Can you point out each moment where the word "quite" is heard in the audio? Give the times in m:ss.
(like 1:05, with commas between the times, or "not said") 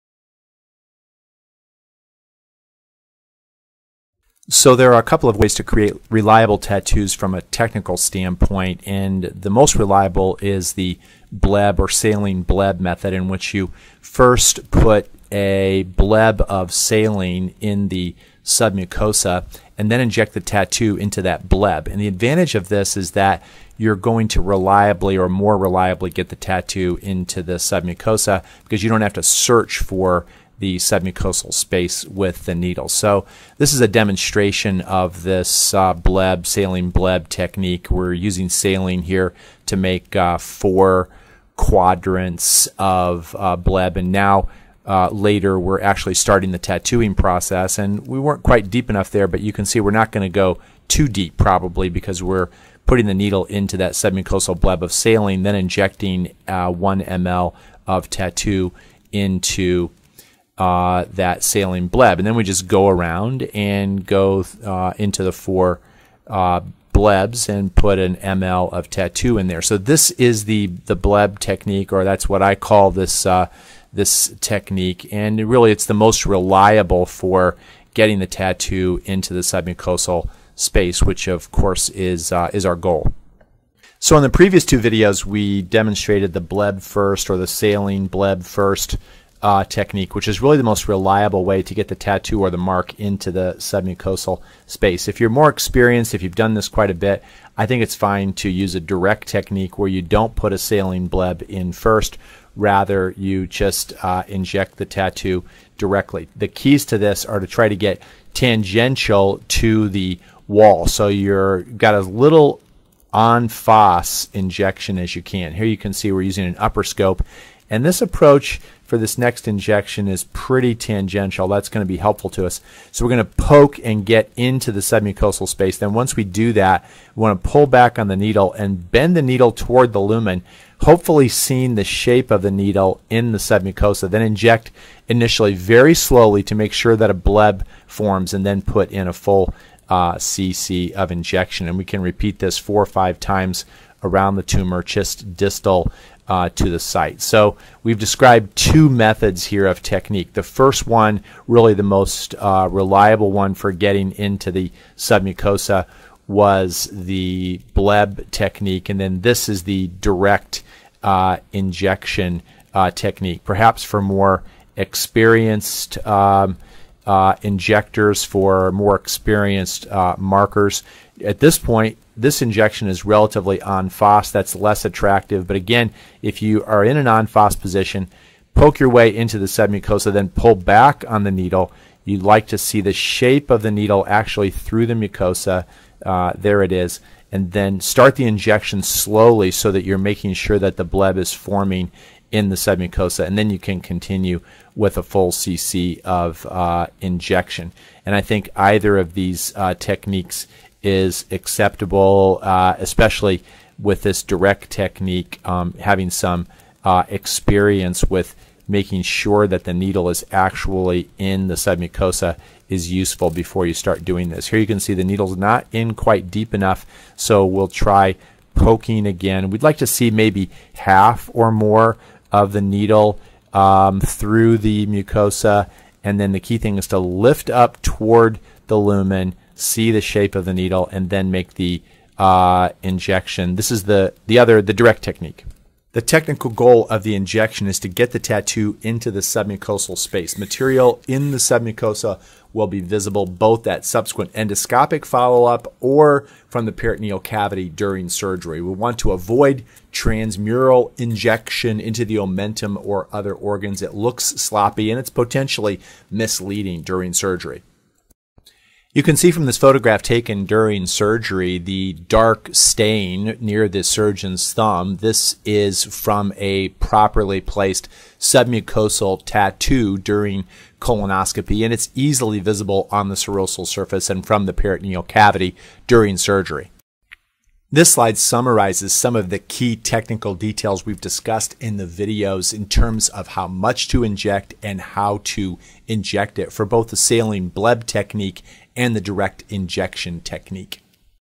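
0:48, 1:36, 3:35.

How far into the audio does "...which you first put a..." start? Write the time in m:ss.
0:13.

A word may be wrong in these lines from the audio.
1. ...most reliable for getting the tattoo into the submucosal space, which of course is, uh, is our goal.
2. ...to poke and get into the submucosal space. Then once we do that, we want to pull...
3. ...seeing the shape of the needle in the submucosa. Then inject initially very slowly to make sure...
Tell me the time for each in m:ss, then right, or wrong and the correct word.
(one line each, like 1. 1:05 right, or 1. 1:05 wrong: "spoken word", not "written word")
1. 1:15 right
2. 2:03 right
3. 2:11 right.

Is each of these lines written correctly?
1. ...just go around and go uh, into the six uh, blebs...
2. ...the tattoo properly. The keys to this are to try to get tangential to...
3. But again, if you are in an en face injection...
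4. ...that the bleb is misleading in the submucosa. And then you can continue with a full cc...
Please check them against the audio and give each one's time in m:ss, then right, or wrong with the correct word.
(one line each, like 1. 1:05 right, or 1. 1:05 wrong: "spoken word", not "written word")
1. 1:02 wrong: "four", not "six"
2. 1:44 wrong: "directly", not "properly"
3. 2:55 wrong: "position", not "injection"
4. 3:10 wrong: "forming", not "misleading".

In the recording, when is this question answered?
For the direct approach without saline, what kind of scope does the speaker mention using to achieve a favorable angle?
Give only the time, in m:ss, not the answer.
1:56.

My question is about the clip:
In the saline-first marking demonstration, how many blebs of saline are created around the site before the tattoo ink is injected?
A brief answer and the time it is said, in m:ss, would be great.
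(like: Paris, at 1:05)
4, at 0:40.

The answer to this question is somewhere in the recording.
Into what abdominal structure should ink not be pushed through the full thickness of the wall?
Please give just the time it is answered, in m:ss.
4:12.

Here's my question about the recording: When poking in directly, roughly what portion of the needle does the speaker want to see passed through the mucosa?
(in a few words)
half or more.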